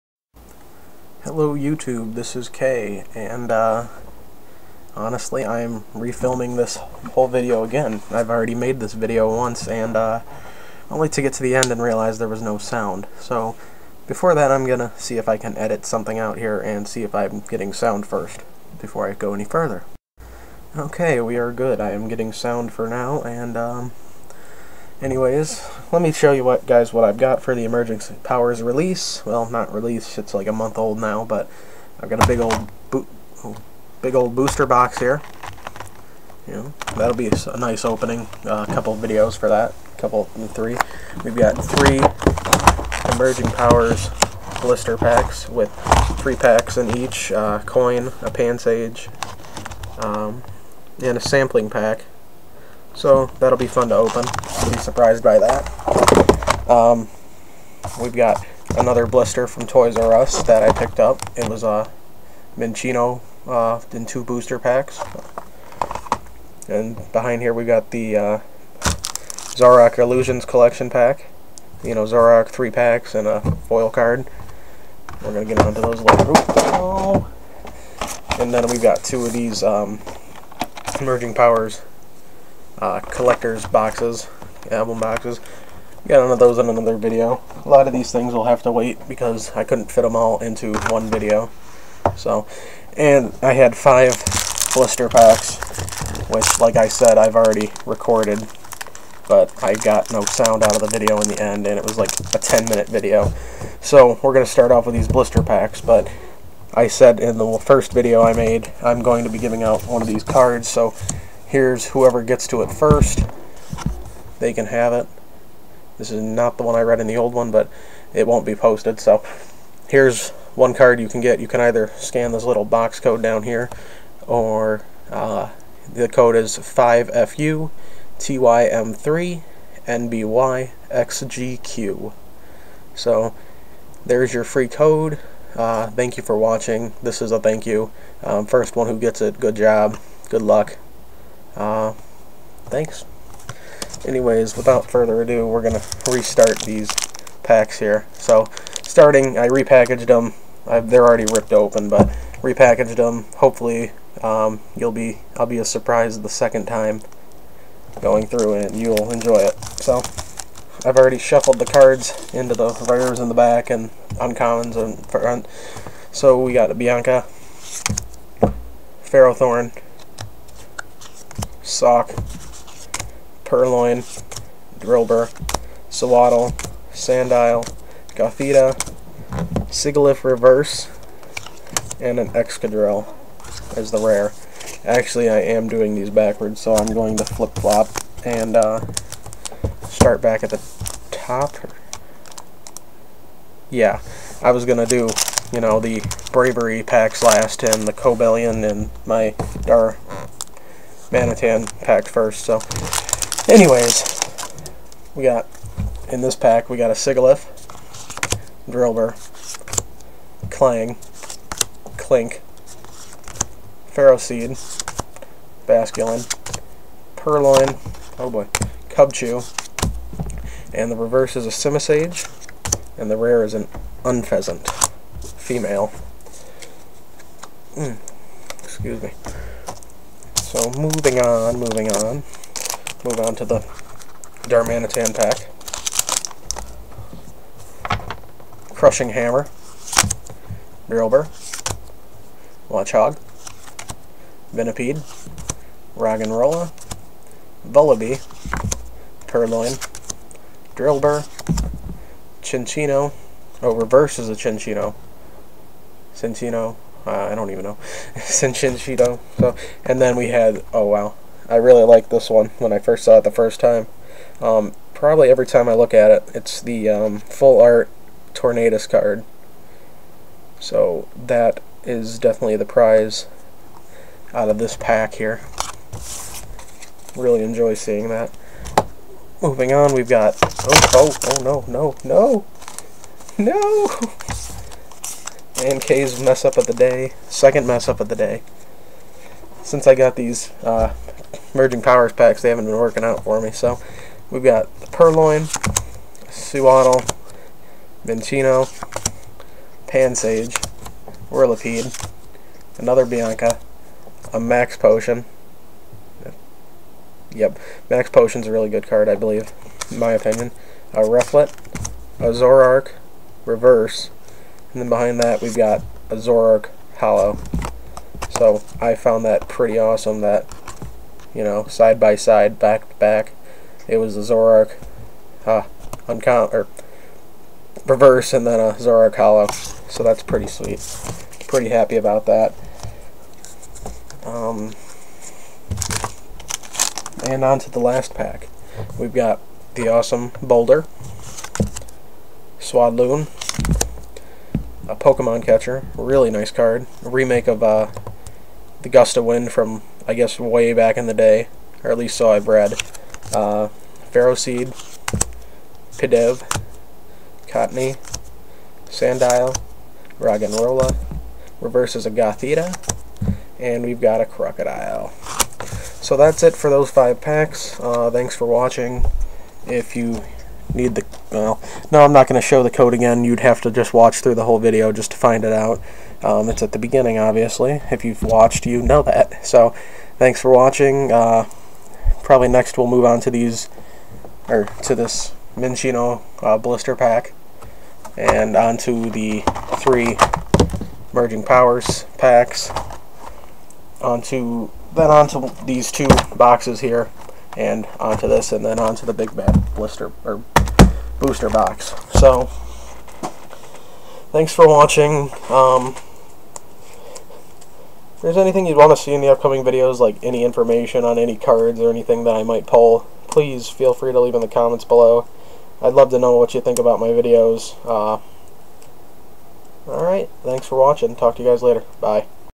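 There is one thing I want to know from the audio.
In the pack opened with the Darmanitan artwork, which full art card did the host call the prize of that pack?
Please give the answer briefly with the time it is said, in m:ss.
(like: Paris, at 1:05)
Tornadus, at 4:28.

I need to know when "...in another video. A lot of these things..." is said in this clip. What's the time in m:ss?
1:26.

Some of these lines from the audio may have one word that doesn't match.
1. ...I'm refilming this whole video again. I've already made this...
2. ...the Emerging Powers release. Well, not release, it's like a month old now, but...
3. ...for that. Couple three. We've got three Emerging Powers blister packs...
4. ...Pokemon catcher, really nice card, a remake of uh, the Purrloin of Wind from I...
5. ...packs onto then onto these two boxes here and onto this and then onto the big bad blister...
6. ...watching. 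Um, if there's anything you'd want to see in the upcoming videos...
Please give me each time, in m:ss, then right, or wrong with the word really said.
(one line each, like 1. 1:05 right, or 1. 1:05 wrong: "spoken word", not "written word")
1. 0:05 right
2. 0:27 right
3. 0:39 right
4. 5:44 wrong: "Gust", not "Purrloin"
5. 6:32 right
6. 6:44 right.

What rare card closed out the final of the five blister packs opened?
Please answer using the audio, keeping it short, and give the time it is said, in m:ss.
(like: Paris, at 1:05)
Krookodile, at 6:04.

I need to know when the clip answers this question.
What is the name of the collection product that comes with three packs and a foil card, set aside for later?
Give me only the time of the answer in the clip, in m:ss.
1:09.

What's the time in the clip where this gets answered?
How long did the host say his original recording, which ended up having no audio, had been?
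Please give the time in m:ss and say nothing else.
1:42.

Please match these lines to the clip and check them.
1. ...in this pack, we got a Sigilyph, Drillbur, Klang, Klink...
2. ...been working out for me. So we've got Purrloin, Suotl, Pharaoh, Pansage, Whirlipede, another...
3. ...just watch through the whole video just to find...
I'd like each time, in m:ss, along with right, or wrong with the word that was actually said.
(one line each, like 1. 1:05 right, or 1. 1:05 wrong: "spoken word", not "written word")
1. 3:26 right
2. 4:52 wrong: "Vincino", not "Pharaoh"
3. 6:13 right.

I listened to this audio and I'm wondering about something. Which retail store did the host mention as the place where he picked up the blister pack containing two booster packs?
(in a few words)
Toys R Us.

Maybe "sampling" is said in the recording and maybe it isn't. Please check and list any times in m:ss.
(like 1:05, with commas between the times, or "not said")
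0:51.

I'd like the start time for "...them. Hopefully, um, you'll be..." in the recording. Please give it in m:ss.
2:32.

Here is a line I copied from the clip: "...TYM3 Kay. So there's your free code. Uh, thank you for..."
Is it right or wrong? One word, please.
wrong.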